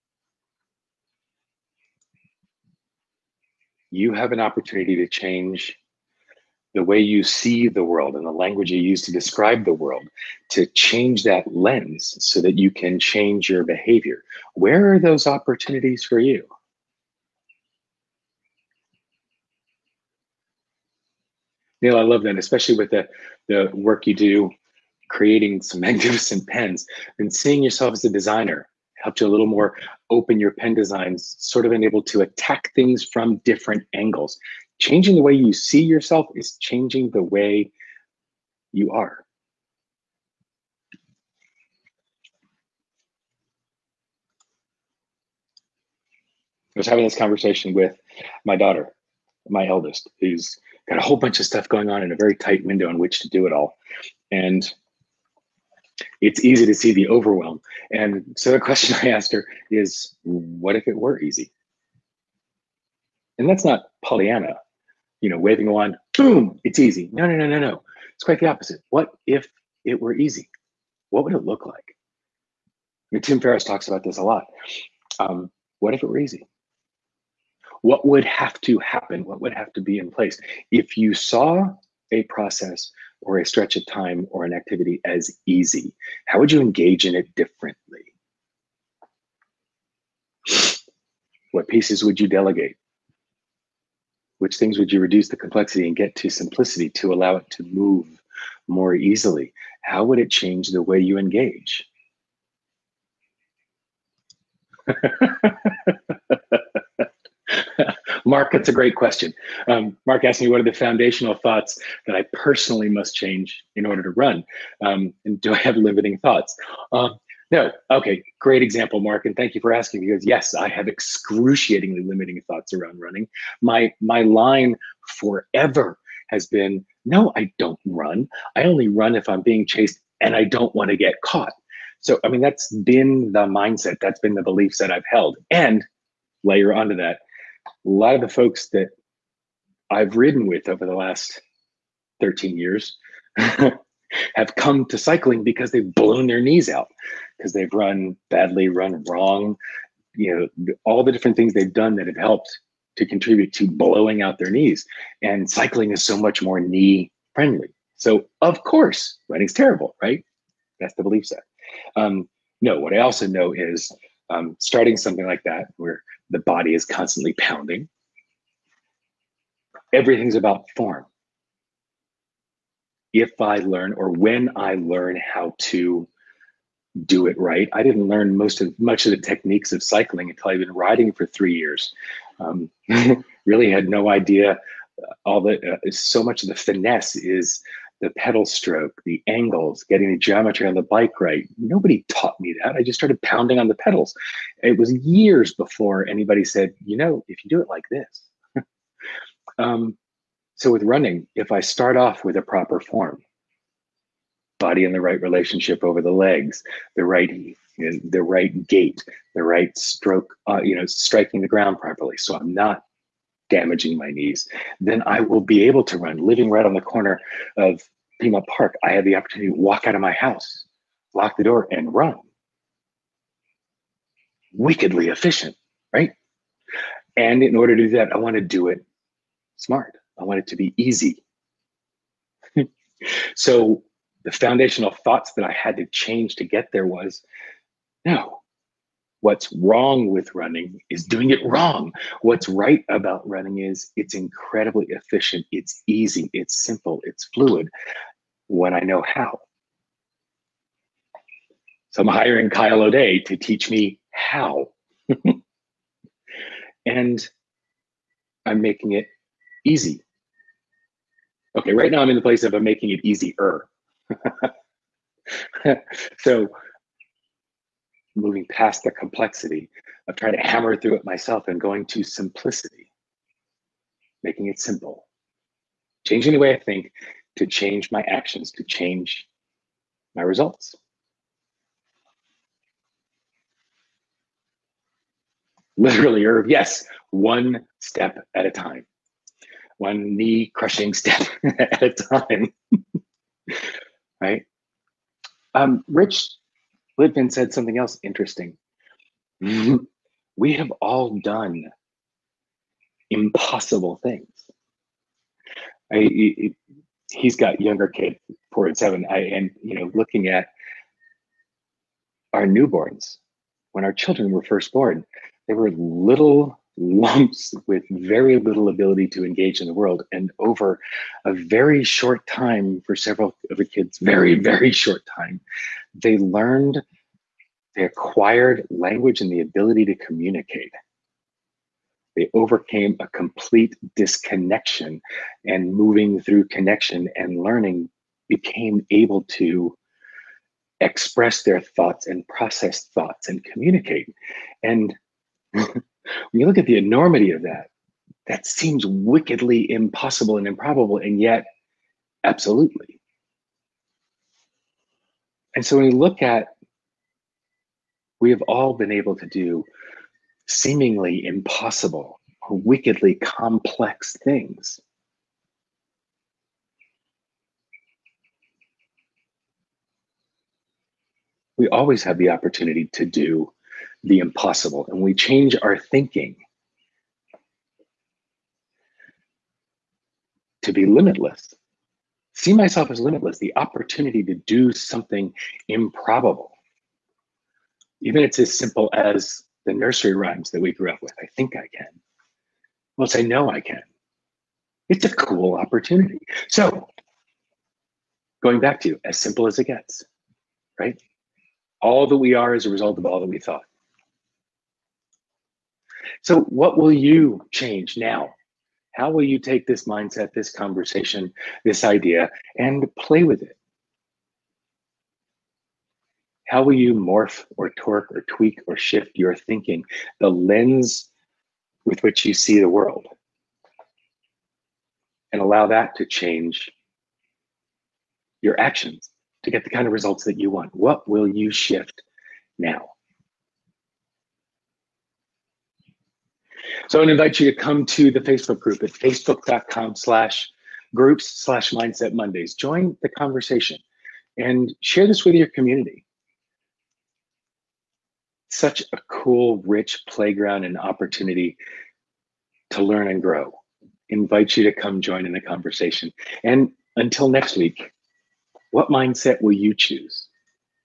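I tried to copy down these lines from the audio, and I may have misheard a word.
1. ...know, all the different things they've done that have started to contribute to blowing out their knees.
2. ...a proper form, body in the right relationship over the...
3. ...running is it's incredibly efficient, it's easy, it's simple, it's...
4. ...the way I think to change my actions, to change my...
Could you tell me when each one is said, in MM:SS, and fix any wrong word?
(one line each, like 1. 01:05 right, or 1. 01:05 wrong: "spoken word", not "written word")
1. 02:30 wrong: "helped", not "started"
2. 03:22 right
3. 04:03 right
4. 04:36 right.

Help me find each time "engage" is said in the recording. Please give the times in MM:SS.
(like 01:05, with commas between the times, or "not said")
01:26, 01:41, 05:19.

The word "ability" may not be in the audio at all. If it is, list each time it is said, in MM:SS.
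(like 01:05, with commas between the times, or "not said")
05:18, 05:29.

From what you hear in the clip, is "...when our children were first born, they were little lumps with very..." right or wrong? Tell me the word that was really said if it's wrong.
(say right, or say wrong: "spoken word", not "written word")
right.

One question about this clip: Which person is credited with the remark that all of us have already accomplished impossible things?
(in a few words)
Rich Litvin.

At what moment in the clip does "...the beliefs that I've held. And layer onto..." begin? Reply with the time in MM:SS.
02:14.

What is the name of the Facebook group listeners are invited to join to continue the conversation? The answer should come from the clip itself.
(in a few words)
Mindset Mondays.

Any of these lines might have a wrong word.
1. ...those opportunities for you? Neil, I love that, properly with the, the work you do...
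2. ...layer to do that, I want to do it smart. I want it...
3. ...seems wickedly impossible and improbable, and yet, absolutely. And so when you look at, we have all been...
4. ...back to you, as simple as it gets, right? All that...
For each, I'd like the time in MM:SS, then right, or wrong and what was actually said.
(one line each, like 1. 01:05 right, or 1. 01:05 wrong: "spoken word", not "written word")
1. 00:14 wrong: "especially", not "properly"
2. 03:47 wrong: "order", not "layer"
3. 05:48 right
4. 06:38 right.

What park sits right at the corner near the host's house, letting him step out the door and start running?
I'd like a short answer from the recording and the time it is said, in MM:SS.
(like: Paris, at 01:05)
Pima Park, at 03:38.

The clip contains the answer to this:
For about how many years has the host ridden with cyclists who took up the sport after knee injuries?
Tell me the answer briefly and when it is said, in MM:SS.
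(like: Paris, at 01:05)
13, at 02:22.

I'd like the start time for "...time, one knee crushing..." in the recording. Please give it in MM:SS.
04:48.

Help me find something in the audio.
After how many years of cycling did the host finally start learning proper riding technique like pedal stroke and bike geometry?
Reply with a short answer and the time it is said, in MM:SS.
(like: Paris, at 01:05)
3, at 03:01.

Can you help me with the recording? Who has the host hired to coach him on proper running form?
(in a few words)
Kyle O'Day.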